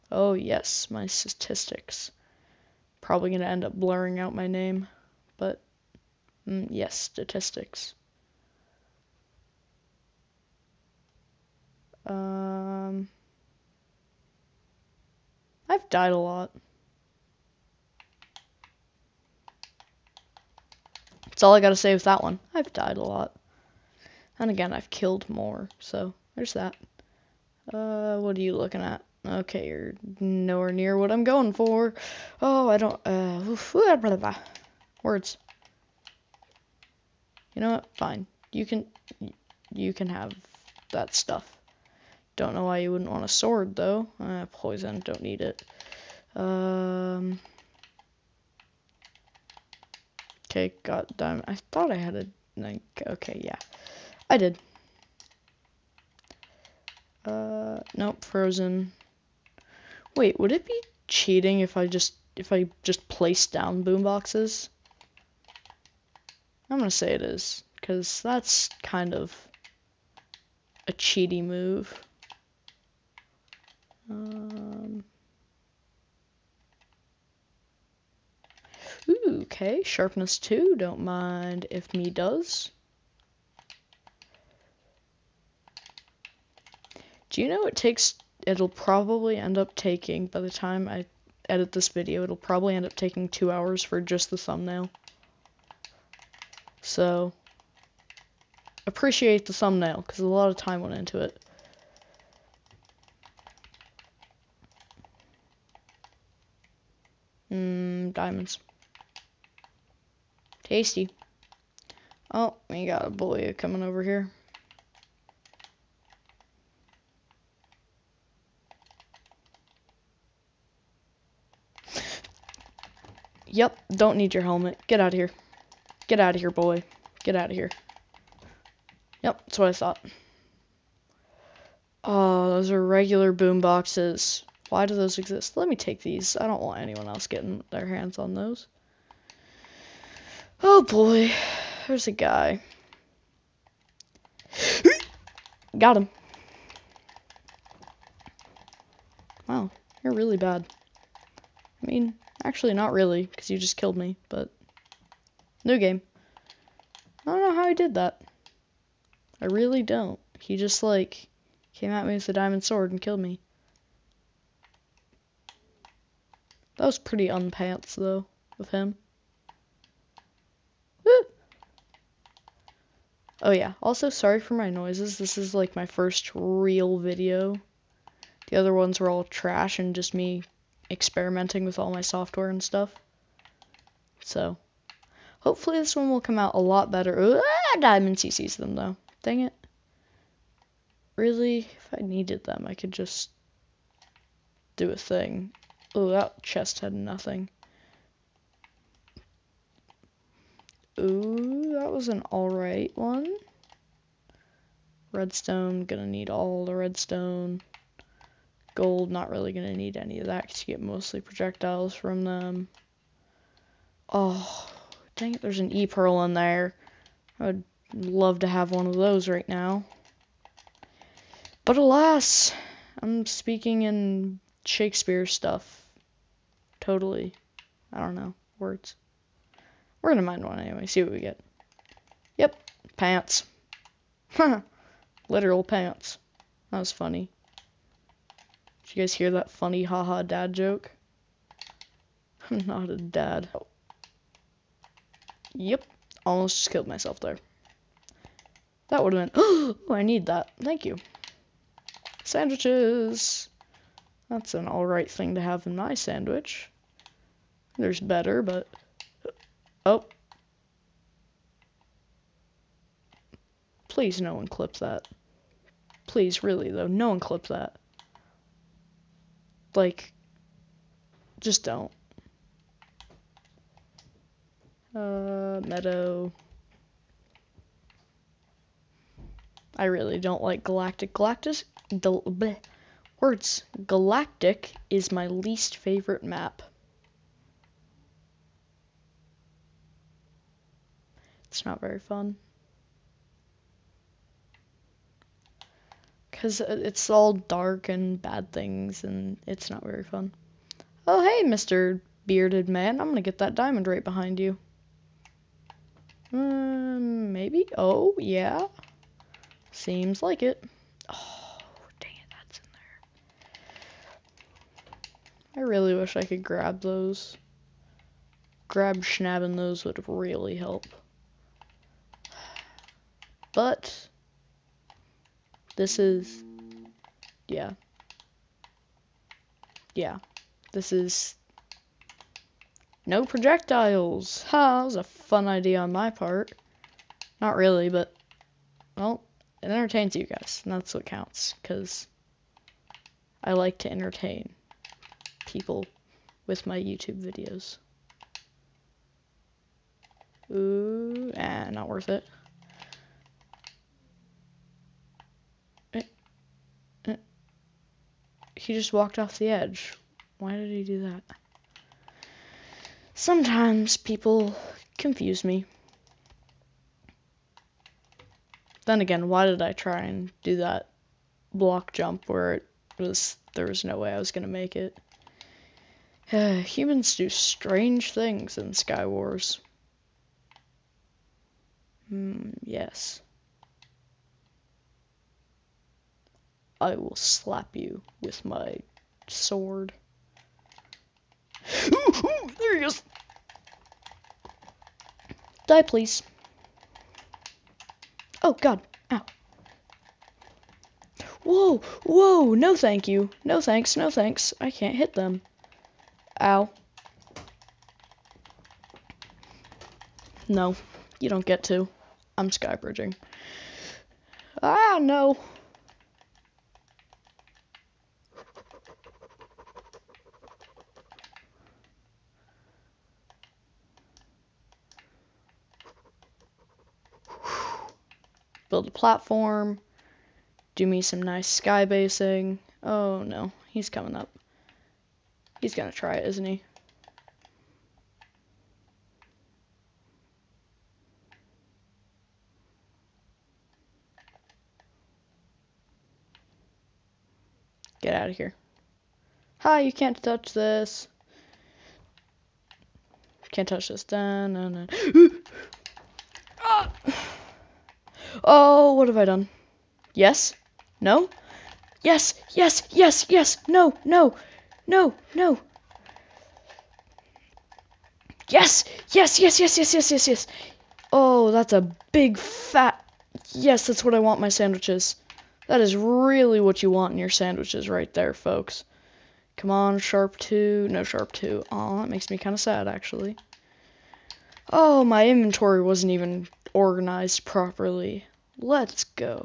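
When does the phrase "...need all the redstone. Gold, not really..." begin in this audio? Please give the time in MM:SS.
03:26.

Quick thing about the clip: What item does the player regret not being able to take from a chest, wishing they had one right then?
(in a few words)
E-Pearl.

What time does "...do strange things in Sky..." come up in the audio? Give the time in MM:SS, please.
06:17.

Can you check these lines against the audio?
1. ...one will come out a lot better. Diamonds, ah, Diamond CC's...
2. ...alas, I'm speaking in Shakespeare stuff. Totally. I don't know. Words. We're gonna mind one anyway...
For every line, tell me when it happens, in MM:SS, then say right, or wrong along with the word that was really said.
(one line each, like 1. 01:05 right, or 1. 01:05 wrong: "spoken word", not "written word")
1. 03:05 right
2. 03:41 right.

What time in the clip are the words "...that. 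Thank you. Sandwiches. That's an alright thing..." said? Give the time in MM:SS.
04:10.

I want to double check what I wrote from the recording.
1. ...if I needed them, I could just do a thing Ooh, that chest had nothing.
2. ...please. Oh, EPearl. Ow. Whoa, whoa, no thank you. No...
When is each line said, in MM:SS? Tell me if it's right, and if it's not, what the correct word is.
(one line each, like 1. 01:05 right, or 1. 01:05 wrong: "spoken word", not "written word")
1. 03:11 right
2. 06:35 wrong: "God", not "EPearl".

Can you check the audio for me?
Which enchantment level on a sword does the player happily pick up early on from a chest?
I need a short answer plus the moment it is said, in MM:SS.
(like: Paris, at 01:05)
Sharpness 2, at 01:19.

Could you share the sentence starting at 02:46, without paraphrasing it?
was pretty unpants though of him.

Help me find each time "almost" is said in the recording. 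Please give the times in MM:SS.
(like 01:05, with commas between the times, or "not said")
04:06.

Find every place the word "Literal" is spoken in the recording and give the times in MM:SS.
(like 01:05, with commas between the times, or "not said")
03:55.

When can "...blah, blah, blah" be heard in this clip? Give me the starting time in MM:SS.
00:33.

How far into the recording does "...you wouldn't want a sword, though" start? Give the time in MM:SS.
00:42.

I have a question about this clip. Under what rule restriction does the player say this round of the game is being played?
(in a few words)
no projectiles.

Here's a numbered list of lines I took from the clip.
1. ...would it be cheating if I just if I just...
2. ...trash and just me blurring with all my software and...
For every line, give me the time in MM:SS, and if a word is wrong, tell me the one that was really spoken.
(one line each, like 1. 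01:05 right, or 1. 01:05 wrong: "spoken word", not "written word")
1. 01:00 right
2. 02:59 wrong: "experimenting", not "blurring".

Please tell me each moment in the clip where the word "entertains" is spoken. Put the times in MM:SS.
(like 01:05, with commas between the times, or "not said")
05:39, 05:43.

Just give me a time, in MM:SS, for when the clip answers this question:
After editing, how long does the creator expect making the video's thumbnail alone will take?
01:33.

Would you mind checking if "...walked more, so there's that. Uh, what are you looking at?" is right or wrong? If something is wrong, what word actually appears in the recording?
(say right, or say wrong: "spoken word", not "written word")
wrong: "killed", not "walked".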